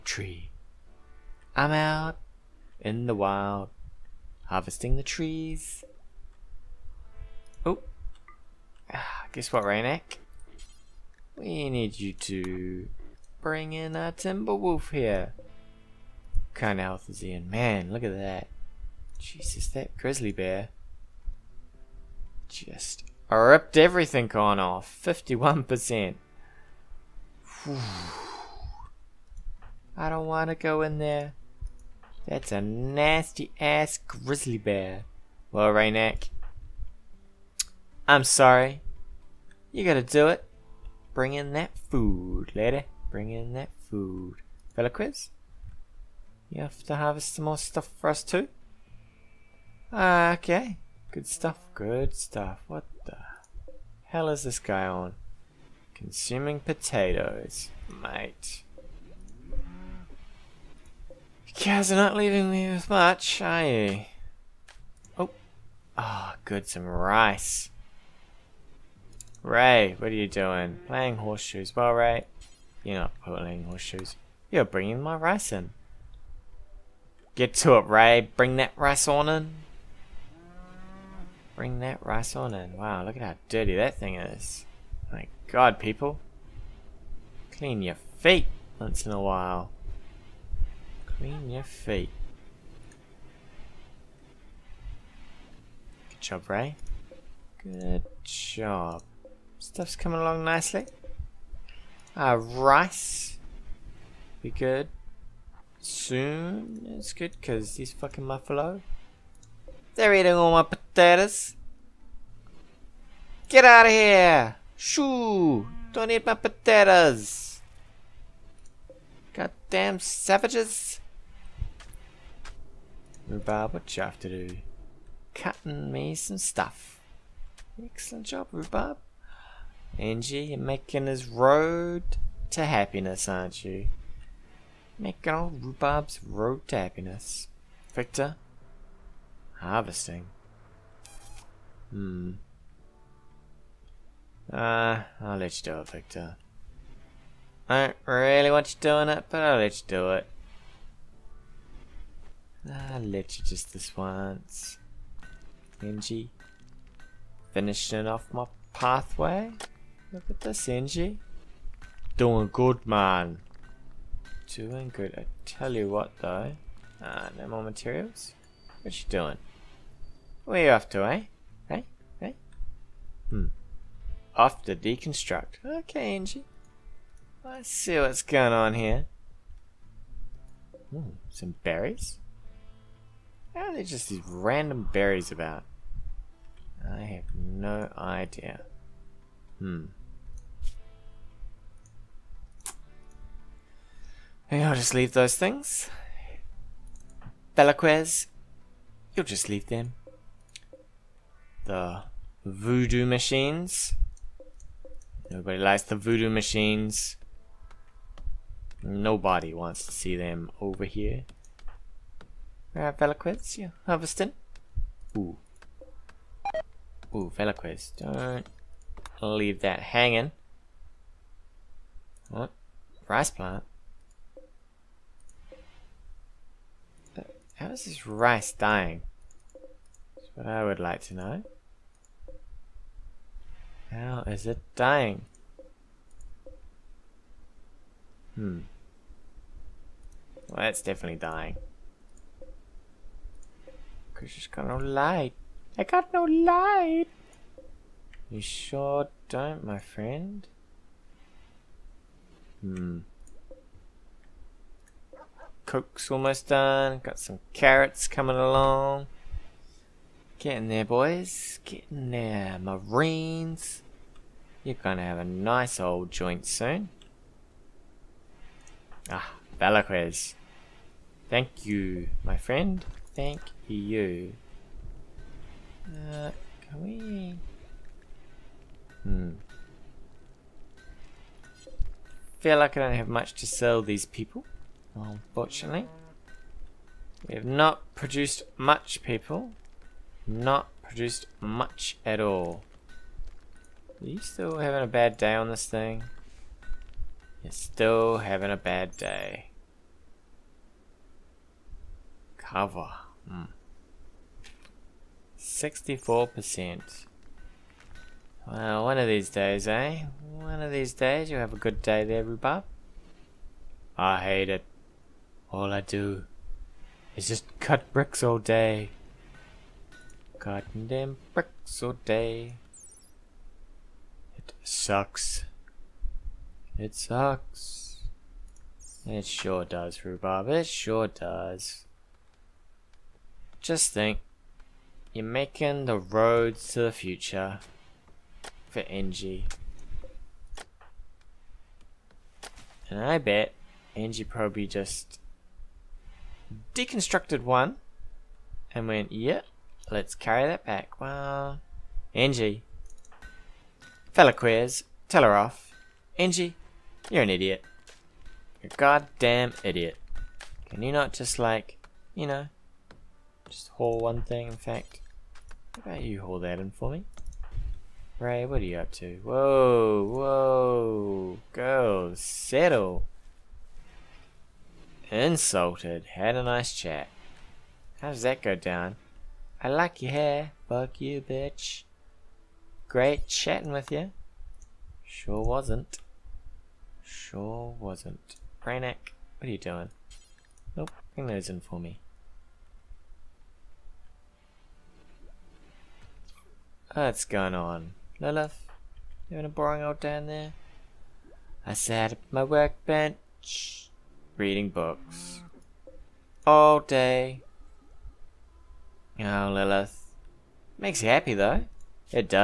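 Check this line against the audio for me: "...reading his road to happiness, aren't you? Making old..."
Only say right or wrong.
wrong.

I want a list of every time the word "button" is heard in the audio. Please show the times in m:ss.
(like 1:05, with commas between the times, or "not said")
not said.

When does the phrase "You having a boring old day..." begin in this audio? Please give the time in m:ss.
6:39.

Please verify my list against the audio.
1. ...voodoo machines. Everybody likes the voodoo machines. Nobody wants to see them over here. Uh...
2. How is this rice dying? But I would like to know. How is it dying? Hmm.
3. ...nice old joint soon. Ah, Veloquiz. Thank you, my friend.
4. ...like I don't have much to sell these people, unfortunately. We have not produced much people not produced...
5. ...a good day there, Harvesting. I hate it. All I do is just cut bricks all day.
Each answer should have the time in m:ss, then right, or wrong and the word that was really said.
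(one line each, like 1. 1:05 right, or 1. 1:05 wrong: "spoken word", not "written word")
1. 3:22 right
2. 3:47 right
3. 4:25 wrong: "Balaquez", not "Veloquiz"
4. 4:42 right
5. 5:11 wrong: "Rhubarb", not "Harvesting".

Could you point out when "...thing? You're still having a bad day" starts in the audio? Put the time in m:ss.
4:55.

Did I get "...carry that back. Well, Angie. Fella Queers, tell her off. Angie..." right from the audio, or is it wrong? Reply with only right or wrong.
right.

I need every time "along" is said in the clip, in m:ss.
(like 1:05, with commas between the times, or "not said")
1:40, 4:18.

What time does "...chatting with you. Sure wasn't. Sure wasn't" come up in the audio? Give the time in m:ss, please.
6:23.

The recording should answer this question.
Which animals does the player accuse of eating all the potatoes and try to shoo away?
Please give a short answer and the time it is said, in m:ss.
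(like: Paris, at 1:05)
Buffalo, at 1:48.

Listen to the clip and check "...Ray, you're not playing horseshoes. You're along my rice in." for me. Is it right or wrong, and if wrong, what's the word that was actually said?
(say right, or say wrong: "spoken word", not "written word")
wrong: "bringing", not "along".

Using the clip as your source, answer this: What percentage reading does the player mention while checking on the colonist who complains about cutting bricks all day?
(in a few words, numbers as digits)
64%.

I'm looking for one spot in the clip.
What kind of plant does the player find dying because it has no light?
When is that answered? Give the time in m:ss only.
3:43.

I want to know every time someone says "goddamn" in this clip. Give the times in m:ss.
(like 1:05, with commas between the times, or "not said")
1:59, 5:58.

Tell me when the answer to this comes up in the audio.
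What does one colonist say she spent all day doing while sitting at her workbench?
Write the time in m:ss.
6:44.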